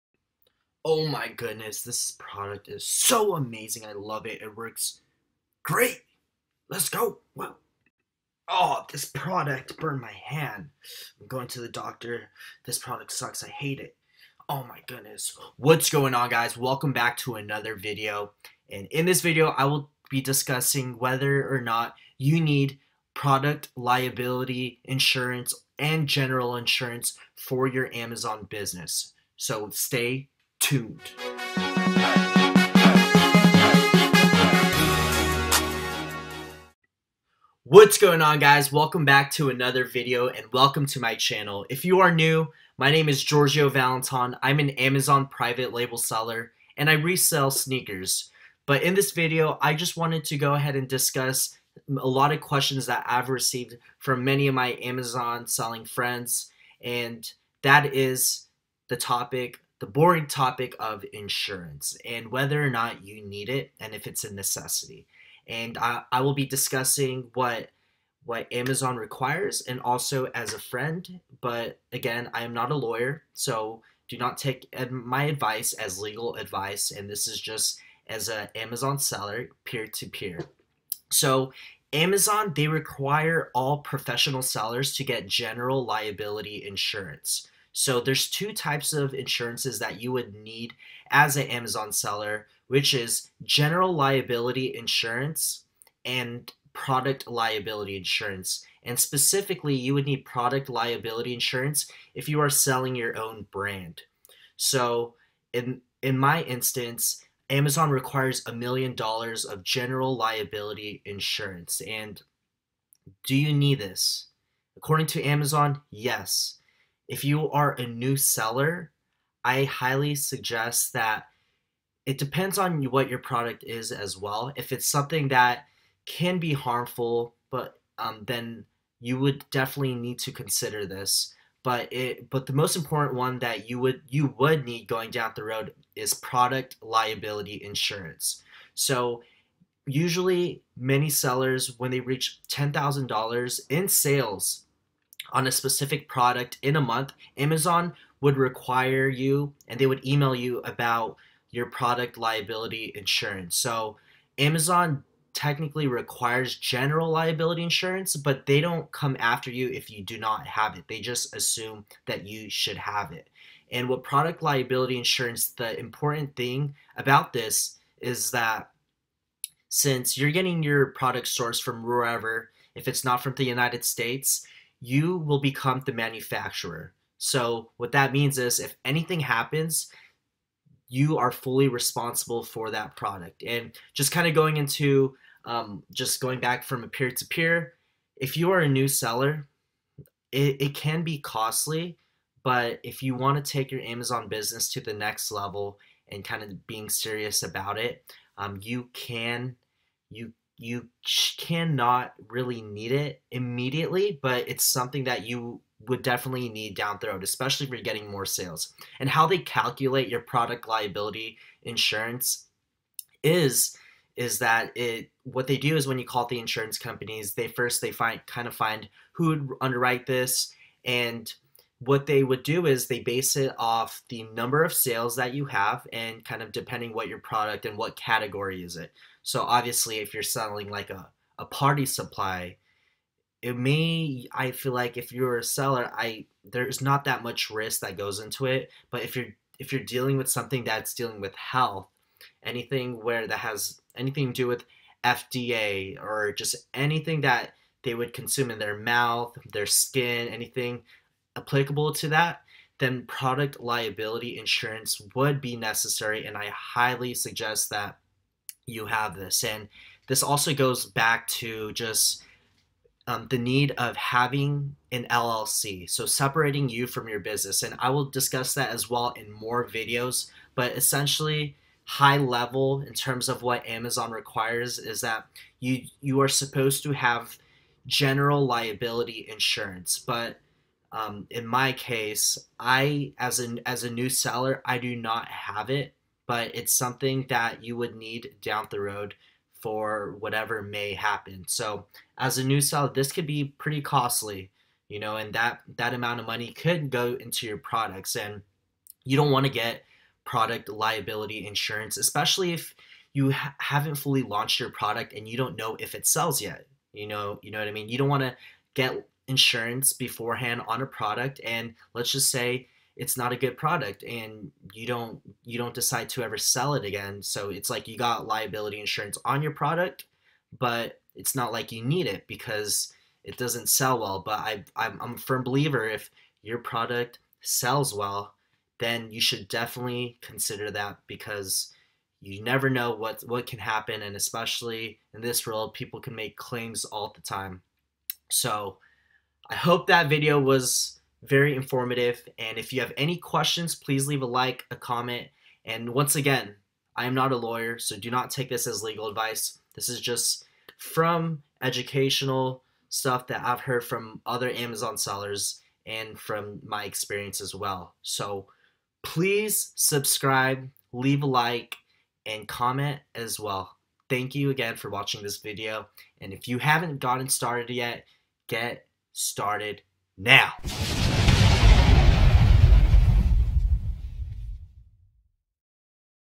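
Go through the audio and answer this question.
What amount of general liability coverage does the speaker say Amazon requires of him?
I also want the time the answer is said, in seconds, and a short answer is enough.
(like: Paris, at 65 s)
$1,000,000, at 108 s.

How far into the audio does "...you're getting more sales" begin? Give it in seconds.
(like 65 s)
207 s.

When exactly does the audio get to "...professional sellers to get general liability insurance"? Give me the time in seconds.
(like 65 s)
83 s.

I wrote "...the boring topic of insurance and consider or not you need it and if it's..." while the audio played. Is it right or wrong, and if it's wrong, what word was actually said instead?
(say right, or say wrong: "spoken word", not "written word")
wrong: "whether", not "consider".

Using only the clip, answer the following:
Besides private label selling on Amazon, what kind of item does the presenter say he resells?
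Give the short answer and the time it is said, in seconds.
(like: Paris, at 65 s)
sneakers, at 47 s.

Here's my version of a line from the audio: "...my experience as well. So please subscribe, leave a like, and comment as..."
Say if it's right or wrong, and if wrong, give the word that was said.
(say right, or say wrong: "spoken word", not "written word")
right.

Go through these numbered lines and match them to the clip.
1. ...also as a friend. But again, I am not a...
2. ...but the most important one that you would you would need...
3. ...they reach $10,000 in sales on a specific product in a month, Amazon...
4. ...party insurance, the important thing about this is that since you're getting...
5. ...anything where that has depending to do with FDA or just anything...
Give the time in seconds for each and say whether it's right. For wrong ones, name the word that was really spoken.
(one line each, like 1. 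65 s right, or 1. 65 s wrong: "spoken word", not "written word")
1. 69 s right
2. 132 s right
3. 141 s right
4. 164 s wrong: "liability", not "party"
5. 242 s wrong: "anything", not "depending".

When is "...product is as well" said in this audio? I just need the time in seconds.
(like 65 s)
123 s.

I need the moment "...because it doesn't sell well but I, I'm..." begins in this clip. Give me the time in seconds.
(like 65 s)
322 s.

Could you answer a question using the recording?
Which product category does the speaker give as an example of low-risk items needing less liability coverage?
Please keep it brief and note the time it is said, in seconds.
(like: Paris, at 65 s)
party supply, at 231 s.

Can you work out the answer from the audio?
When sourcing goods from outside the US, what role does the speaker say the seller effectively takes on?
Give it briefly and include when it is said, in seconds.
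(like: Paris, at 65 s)
manufacturer, at 175 s.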